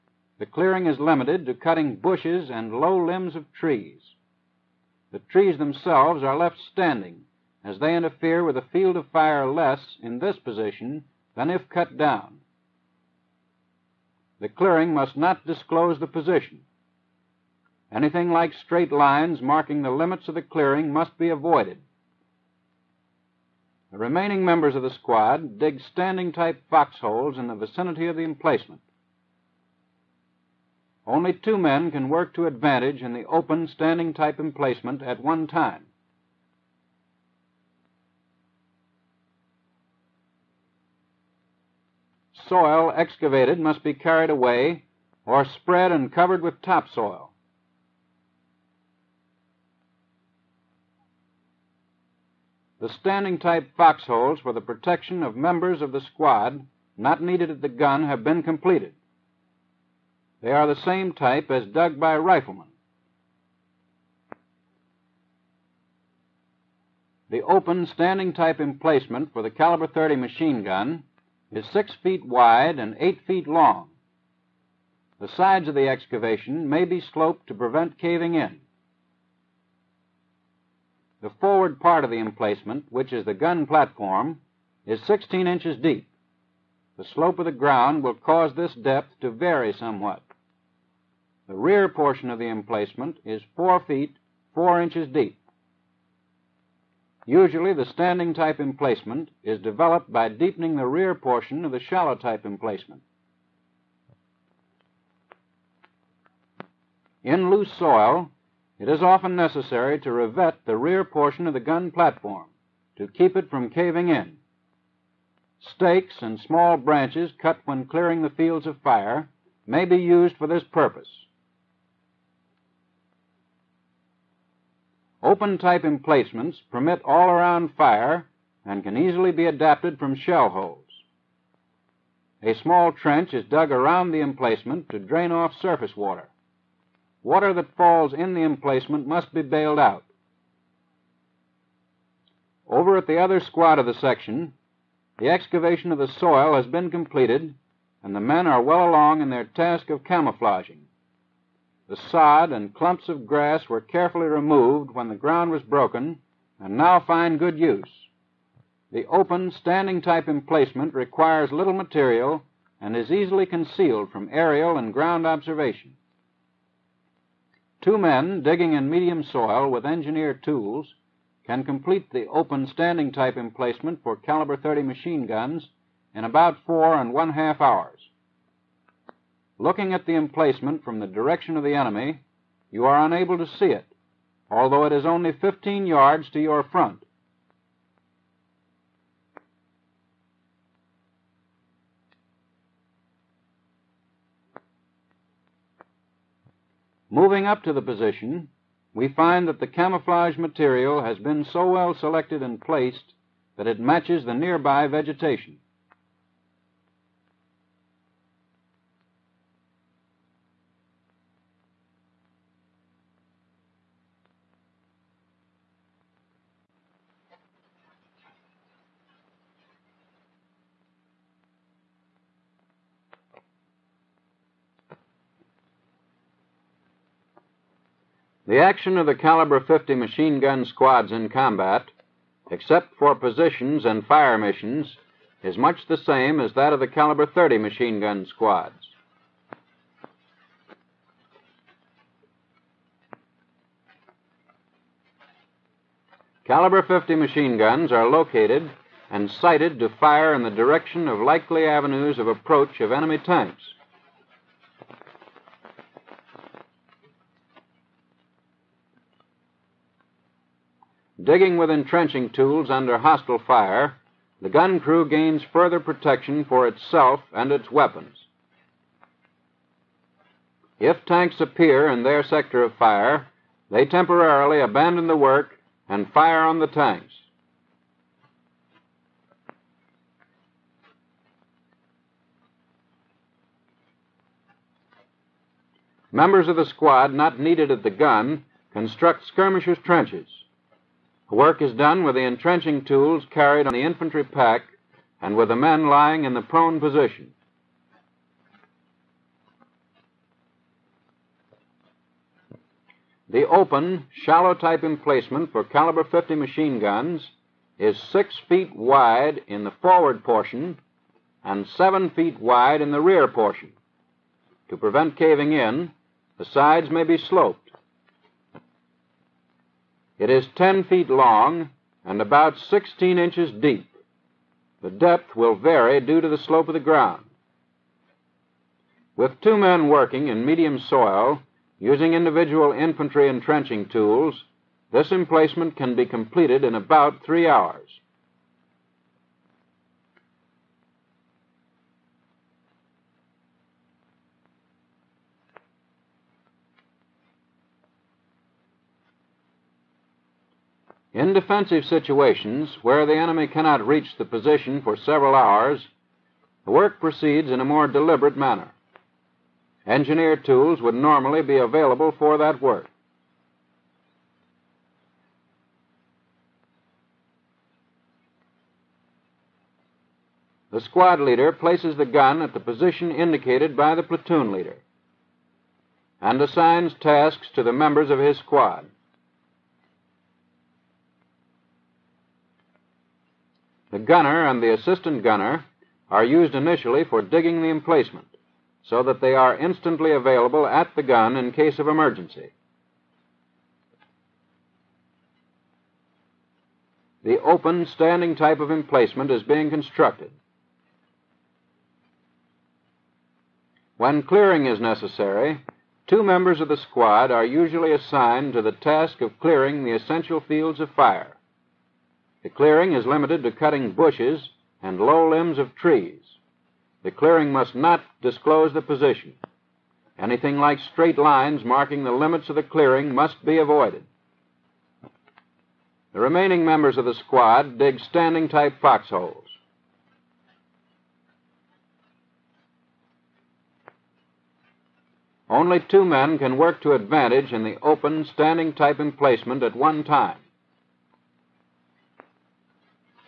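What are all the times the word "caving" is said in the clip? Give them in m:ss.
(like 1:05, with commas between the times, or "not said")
1:17, 1:53, 5:15.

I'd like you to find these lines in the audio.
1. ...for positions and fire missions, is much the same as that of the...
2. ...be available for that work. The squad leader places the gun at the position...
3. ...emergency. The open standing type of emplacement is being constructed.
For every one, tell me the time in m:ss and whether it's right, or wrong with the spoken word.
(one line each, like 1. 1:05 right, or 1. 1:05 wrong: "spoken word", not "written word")
1. 3:52 right
2. 6:01 right
3. 6:31 right.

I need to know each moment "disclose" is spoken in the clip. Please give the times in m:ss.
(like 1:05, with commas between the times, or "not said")
0:15, 6:58.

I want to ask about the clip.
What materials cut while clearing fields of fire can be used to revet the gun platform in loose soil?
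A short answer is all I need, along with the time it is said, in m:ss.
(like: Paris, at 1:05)
Stakes and small branches, at 1:55.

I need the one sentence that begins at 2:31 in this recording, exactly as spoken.
The sod and clumps of grass were carefully removed when the ground was broken, and now find good use.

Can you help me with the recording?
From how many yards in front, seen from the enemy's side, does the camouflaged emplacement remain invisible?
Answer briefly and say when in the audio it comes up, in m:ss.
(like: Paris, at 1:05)
15 yards, at 3:05.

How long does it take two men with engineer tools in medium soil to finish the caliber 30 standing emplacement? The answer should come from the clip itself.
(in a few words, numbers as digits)
About 4.5 hours.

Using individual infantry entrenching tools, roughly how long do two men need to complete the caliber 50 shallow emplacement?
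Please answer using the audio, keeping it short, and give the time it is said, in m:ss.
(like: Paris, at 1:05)
About 3 hours, at 5:37.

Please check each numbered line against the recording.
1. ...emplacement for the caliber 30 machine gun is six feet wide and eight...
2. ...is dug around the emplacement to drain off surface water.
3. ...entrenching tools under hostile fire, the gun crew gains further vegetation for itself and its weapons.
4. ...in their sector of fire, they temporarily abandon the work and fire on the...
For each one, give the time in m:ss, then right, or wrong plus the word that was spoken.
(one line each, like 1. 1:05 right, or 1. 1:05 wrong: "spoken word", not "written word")
1. 1:08 right
2. 2:13 right
3. 4:21 wrong: "protection", not "vegetation"
4. 4:31 right.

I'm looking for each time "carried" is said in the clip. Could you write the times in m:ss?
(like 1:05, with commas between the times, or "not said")
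0:43, 4:53.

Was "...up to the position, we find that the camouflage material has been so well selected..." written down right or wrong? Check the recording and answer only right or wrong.
right.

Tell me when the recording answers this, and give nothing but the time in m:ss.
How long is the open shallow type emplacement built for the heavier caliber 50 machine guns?
5:20.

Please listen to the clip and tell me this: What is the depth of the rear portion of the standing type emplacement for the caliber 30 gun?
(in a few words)
4 feet 4 inches.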